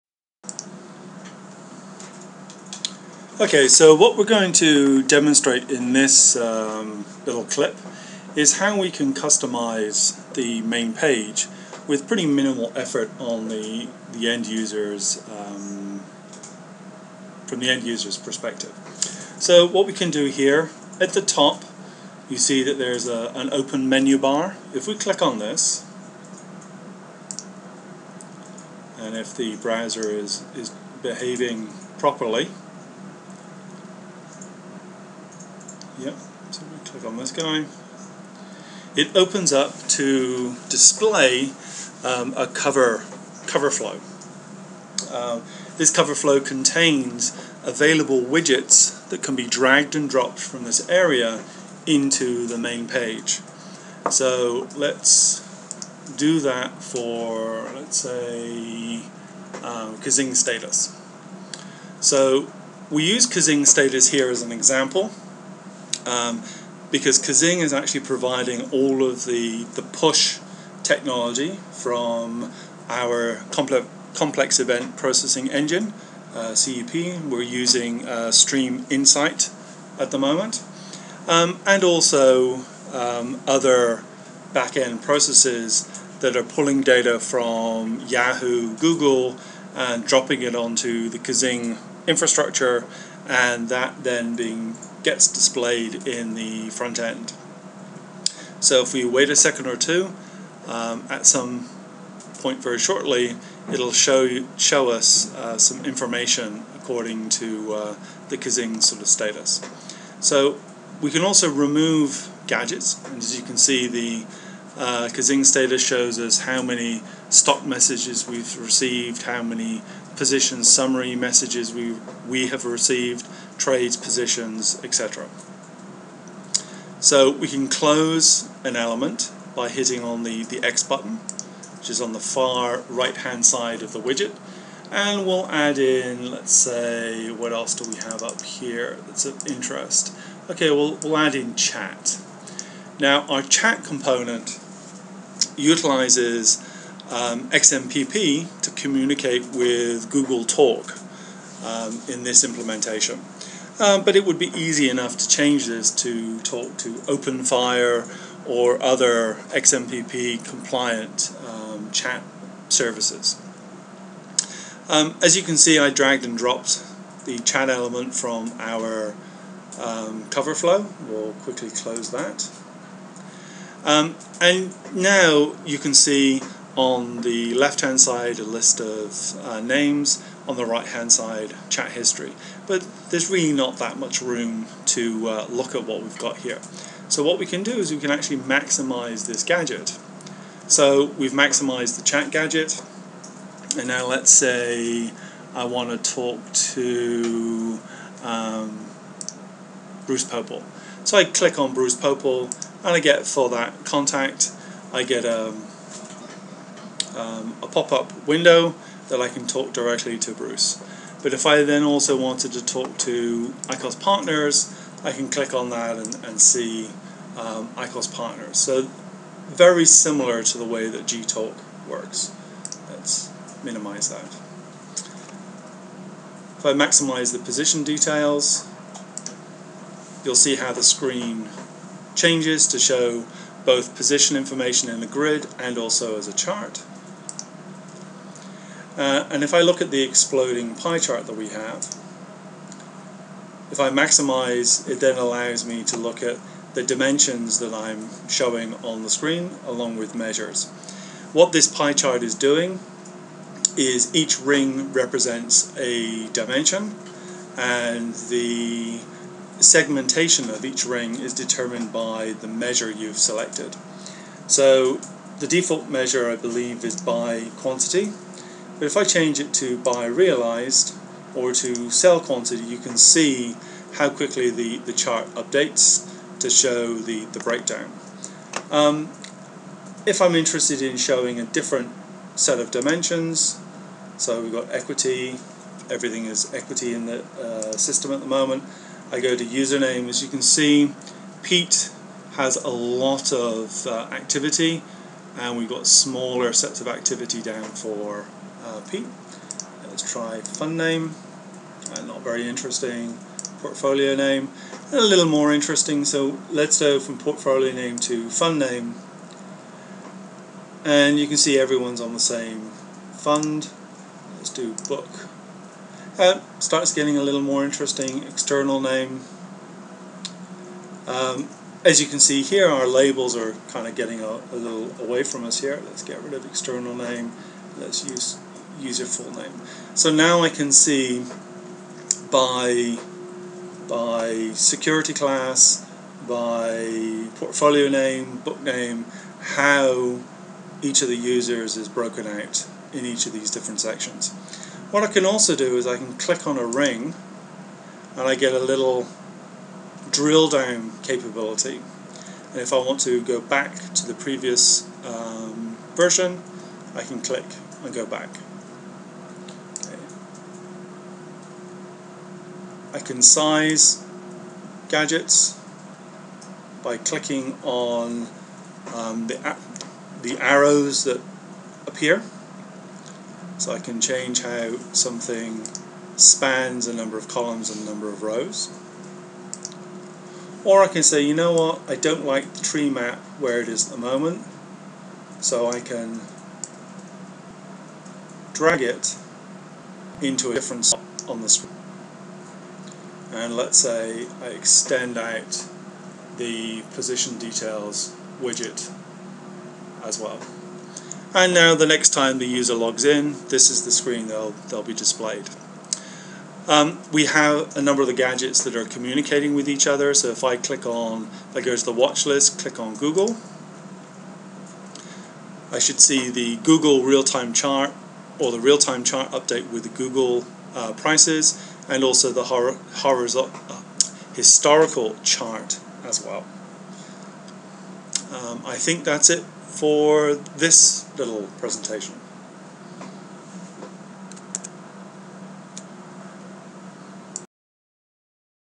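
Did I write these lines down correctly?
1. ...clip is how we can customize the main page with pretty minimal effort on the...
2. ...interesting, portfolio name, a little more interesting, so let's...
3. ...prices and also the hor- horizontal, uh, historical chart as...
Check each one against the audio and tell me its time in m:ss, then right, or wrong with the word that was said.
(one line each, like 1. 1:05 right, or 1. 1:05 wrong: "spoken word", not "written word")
1. 0:07 right
2. 5:02 right
3. 7:00 right.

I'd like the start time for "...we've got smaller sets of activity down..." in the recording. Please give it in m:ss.
4:55.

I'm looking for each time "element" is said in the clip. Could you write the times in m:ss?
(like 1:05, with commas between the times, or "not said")
2:08, 2:47.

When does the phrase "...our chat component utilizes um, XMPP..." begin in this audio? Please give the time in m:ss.
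2:23.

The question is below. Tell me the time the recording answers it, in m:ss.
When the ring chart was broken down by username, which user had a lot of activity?
4:51.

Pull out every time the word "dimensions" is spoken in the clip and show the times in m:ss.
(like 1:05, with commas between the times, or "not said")
4:06, 4:16, 4:42.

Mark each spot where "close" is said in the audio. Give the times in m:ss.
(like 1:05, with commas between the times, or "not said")
2:07, 2:51.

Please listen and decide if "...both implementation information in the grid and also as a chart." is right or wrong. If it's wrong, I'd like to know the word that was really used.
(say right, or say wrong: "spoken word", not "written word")
wrong: "position", not "implementation".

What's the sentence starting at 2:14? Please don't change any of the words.
And we'll add in, let's say, what else do we have up here that's of interest?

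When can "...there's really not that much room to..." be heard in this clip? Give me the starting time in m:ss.
3:03.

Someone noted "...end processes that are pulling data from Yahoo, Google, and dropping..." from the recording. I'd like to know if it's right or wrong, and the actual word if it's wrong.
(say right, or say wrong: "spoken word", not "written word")
right.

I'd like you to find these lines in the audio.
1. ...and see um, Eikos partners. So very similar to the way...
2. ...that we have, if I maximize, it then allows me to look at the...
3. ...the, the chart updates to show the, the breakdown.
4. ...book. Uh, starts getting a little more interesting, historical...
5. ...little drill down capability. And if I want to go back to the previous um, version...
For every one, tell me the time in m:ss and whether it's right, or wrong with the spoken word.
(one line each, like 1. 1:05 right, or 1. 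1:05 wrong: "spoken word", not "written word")
1. 3:36 right
2. 4:01 right
3. 4:34 right
4. 5:14 wrong: "external", not "historical"
5. 5:48 right.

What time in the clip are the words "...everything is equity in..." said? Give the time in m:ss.
4:45.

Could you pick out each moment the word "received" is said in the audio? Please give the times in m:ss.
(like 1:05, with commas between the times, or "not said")
1:58, 2:02.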